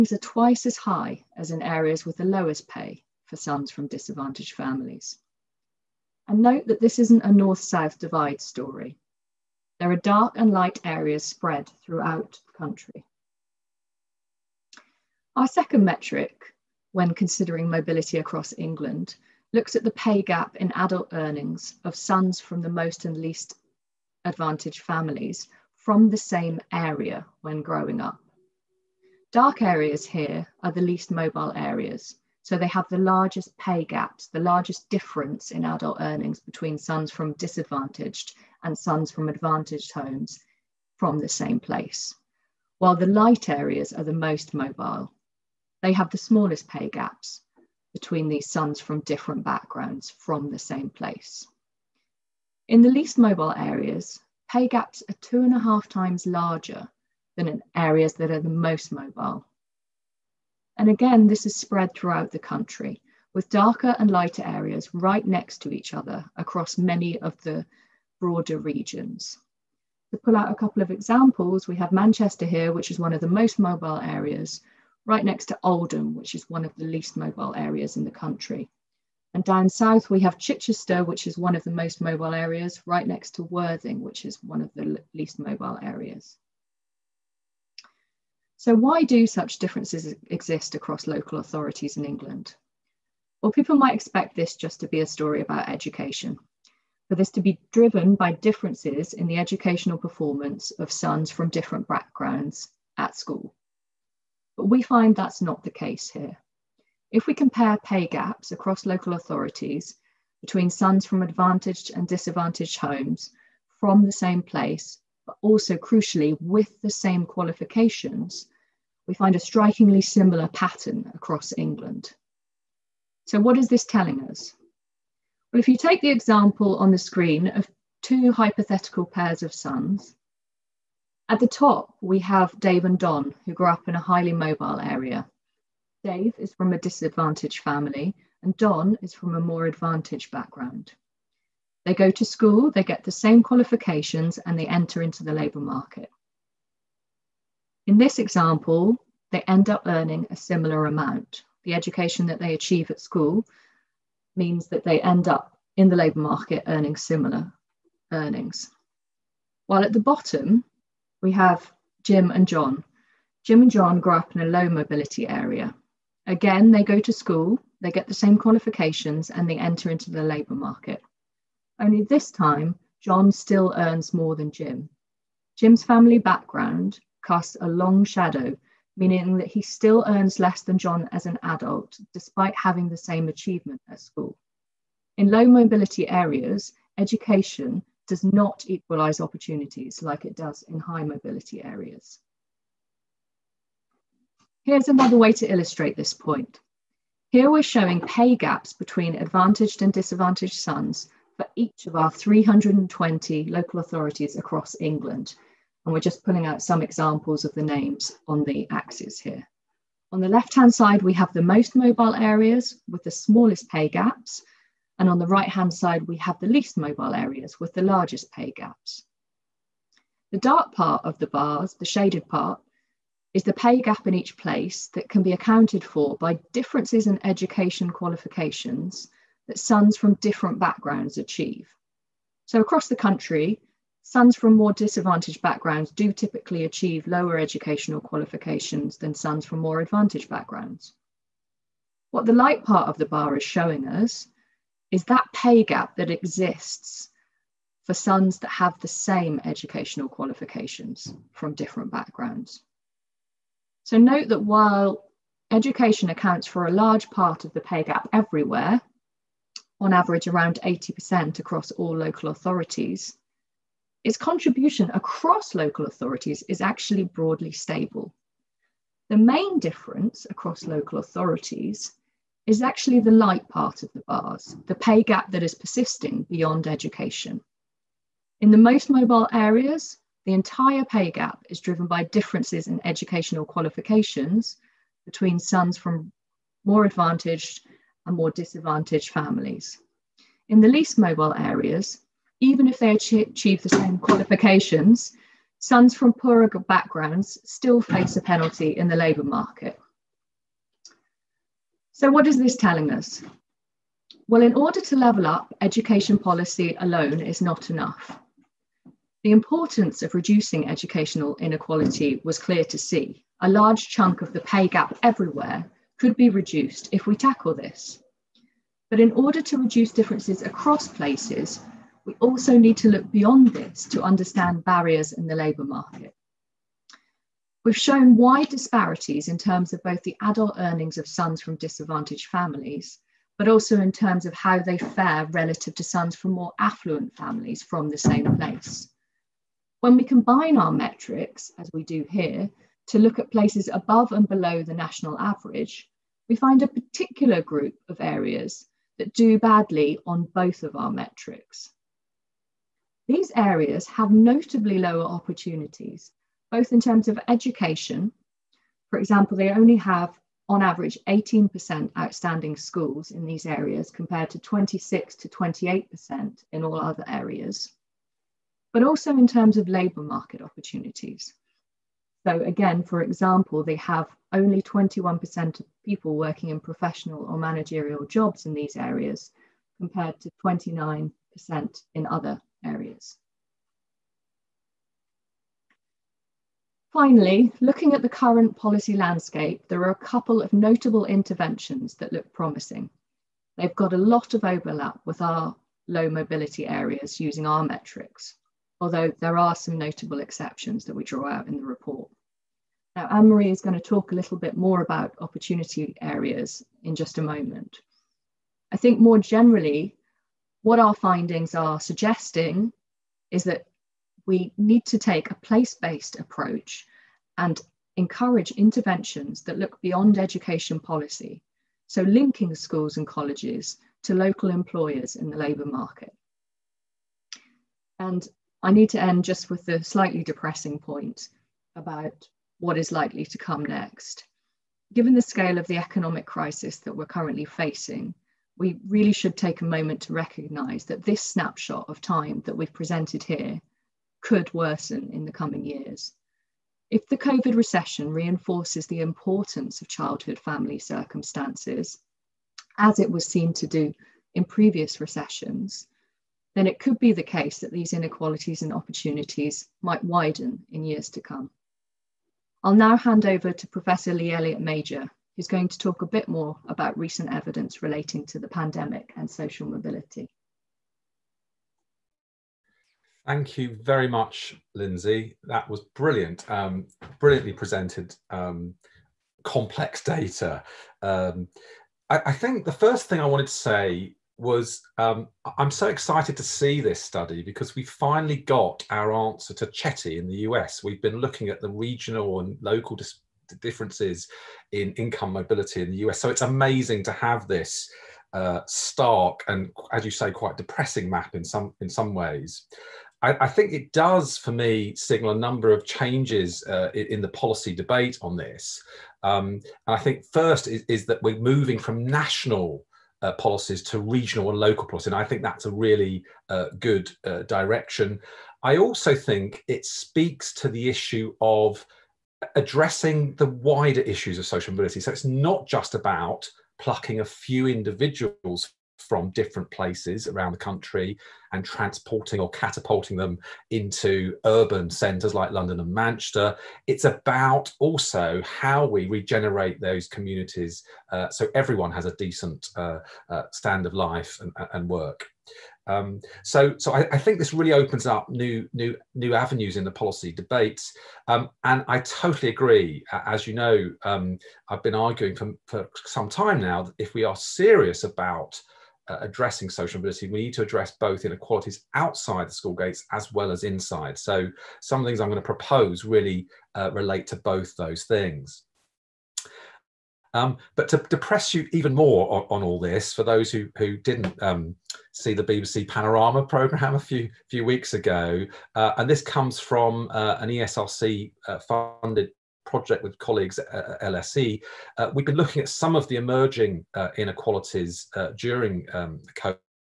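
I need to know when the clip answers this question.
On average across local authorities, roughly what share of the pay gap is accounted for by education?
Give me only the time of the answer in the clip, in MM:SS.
04:20.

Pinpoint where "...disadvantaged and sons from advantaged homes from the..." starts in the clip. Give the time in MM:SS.
00:37.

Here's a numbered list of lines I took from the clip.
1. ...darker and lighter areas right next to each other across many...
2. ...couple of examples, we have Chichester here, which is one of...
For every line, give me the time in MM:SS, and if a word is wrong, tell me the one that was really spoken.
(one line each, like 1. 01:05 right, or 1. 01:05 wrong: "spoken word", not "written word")
1. 01:03 right
2. 01:10 wrong: "Manchester", not "Chichester".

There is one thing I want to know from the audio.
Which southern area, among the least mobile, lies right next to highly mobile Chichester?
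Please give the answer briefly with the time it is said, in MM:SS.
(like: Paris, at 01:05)
Worthing, at 01:23.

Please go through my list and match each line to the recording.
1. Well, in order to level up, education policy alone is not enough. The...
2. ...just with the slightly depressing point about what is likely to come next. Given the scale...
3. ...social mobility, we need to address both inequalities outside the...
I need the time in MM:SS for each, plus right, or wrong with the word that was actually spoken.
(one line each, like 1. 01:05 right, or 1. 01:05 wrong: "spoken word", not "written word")
1. 05:04 right
2. 07:09 right
3. 09:19 right.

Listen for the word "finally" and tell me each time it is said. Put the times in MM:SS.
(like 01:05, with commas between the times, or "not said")
06:26, 08:07.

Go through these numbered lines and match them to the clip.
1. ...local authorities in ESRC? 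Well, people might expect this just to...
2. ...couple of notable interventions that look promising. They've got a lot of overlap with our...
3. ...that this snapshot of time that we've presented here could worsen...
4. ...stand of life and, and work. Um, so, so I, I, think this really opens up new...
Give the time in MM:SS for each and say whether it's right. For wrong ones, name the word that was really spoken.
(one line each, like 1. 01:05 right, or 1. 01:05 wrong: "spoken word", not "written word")
1. 01:31 wrong: "England", not "ESRC"
2. 06:30 right
3. 07:20 right
4. 09:03 right.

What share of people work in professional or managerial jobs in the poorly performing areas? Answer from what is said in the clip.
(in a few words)
21%.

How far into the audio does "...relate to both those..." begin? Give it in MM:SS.
09:26.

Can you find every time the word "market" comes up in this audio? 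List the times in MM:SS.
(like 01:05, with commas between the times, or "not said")
02:25, 02:36, 02:50, 04:59, 05:25, 06:10, 07:05.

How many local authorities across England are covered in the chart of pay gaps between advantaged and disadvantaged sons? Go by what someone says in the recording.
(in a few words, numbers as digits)
320.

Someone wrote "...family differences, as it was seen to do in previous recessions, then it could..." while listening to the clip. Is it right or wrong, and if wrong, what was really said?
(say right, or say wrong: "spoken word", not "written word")
wrong: "circumstances", not "differences".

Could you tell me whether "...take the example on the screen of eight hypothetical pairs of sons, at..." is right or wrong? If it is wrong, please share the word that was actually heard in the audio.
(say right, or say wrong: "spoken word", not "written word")
wrong: "two", not "eight".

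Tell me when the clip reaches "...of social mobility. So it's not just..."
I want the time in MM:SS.
08:44.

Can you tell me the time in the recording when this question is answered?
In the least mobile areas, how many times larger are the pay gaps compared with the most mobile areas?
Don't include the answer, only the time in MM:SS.
00:55.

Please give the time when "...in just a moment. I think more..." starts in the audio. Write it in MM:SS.
06:46.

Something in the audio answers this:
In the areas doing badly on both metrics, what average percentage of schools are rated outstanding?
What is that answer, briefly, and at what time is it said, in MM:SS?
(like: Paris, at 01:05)
18%, at 06:01.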